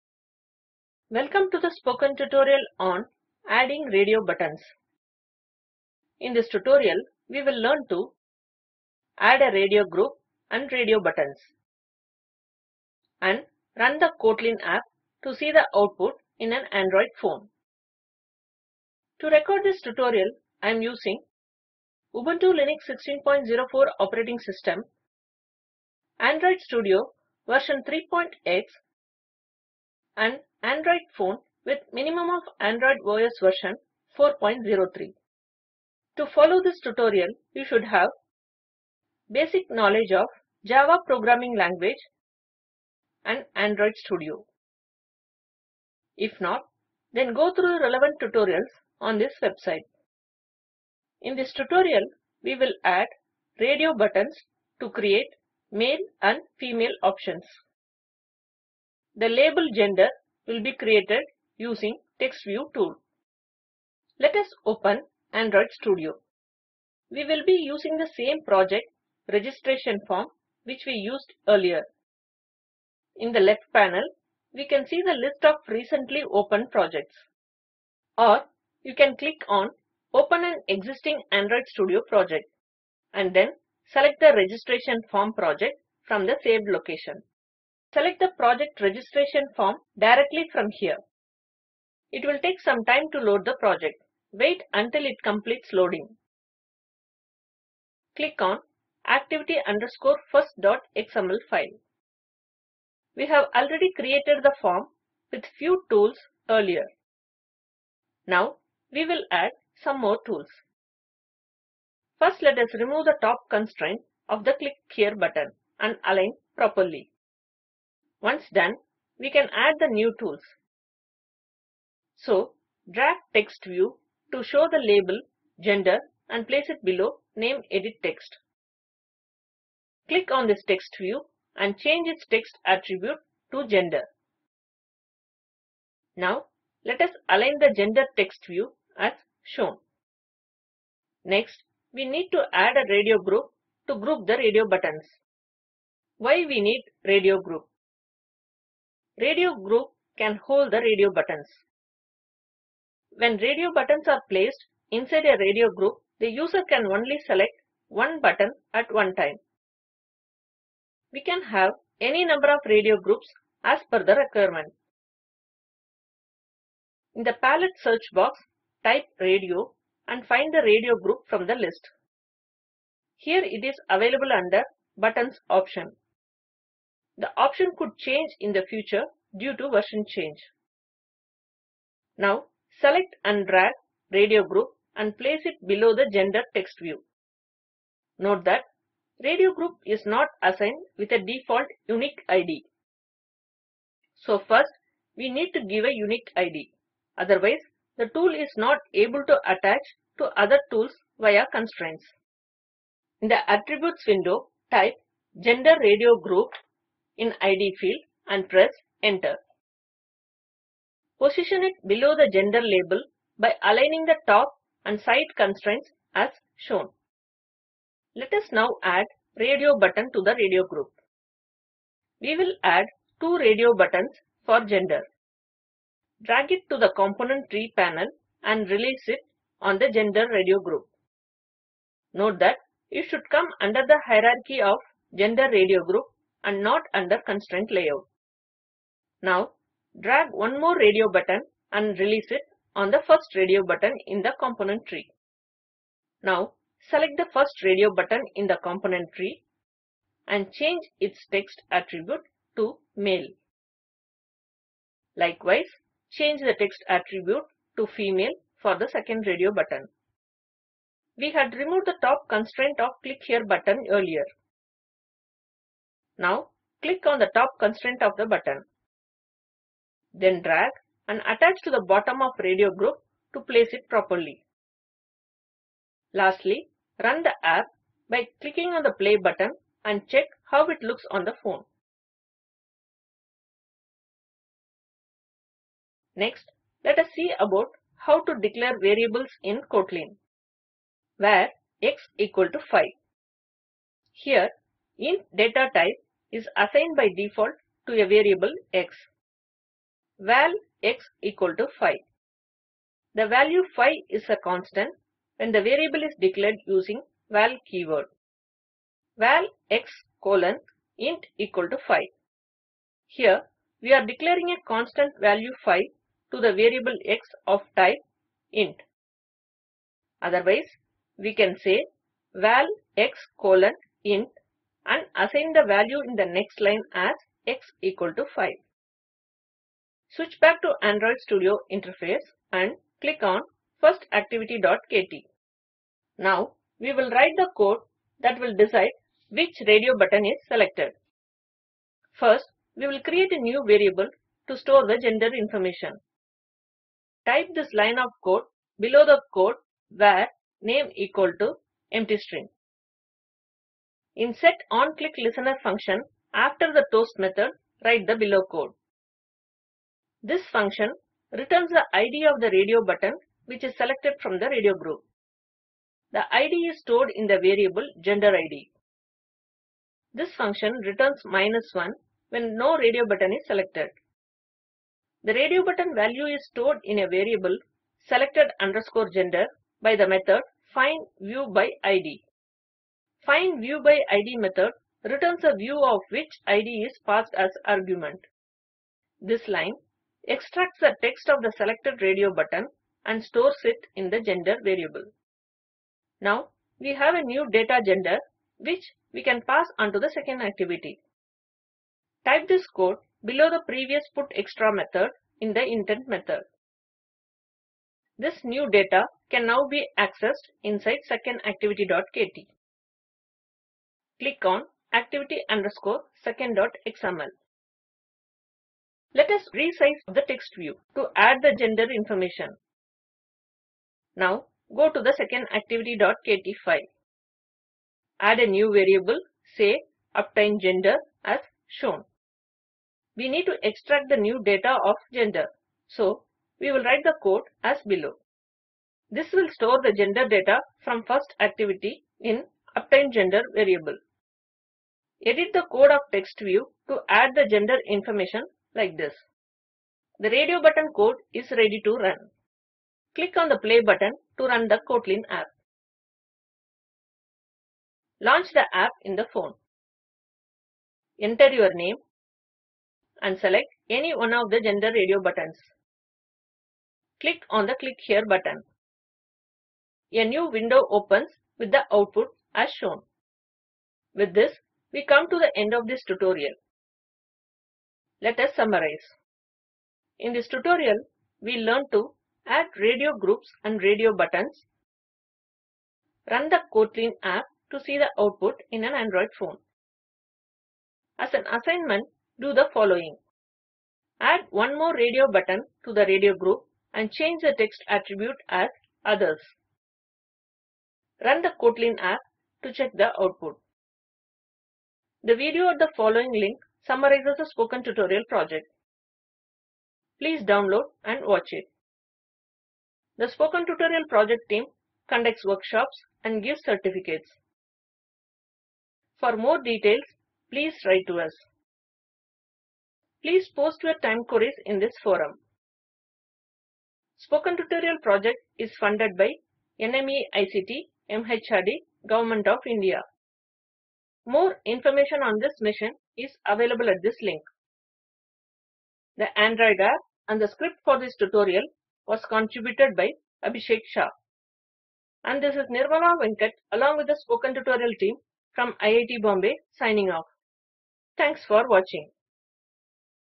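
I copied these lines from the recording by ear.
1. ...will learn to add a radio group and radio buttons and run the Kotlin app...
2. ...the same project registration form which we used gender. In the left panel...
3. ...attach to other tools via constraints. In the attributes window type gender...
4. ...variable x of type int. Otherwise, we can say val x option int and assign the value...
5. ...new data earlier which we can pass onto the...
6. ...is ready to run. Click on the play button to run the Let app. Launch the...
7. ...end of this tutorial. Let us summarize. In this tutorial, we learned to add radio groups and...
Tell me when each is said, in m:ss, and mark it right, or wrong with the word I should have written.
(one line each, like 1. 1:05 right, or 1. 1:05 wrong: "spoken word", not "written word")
1. 0:07 right
2. 1:07 wrong: "earlier", not "gender"
3. 3:19 right
4. 5:16 wrong: "colon", not "option"
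5. 6:37 wrong: "gender", not "earlier"
6. 7:31 wrong: "Kotlin", not "Let"
7. 7:55 right.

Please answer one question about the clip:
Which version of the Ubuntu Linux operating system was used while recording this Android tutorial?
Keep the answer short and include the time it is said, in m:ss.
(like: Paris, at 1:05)
16.04, at 0:22.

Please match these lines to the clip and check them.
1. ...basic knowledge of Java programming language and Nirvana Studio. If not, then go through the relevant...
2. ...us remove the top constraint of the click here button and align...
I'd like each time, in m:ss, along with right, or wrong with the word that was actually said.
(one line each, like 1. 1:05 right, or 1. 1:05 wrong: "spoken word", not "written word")
1. 0:39 wrong: "Android", not "Nirvana"
2. 1:52 right.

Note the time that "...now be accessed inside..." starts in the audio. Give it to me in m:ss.
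6:49.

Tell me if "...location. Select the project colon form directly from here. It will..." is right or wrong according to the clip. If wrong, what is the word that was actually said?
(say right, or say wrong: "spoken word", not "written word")
wrong: "registration", not "colon".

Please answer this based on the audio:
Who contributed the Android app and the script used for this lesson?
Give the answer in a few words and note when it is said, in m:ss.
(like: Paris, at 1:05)
Abhishek Shah, at 9:03.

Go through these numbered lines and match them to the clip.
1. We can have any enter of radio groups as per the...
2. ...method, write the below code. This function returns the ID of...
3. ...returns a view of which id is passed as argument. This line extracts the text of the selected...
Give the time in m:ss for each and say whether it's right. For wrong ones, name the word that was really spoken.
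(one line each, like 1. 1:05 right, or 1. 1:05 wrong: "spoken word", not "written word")
1. 2:41 wrong: "number", not "enter"
2. 5:57 right
3. 6:25 right.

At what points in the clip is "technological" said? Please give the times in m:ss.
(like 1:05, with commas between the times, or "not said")
not said.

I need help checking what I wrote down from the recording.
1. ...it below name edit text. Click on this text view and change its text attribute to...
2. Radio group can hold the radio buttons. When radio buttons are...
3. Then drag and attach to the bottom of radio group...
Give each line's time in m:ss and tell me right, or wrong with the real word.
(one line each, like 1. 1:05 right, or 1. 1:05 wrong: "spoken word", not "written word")
1. 2:06 right
2. 2:29 right
3. 4:30 right.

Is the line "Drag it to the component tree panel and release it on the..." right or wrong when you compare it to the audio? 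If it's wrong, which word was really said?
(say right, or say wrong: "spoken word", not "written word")
right.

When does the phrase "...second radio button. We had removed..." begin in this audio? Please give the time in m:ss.
4:18.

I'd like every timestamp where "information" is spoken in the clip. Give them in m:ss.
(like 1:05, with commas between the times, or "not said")
5:45, 7:01, 7:27, 8:54.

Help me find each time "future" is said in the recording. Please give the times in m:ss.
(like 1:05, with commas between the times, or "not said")
2:58.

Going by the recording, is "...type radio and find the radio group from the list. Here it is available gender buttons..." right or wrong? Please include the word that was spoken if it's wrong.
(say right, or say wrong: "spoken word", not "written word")
wrong: "under", not "gender".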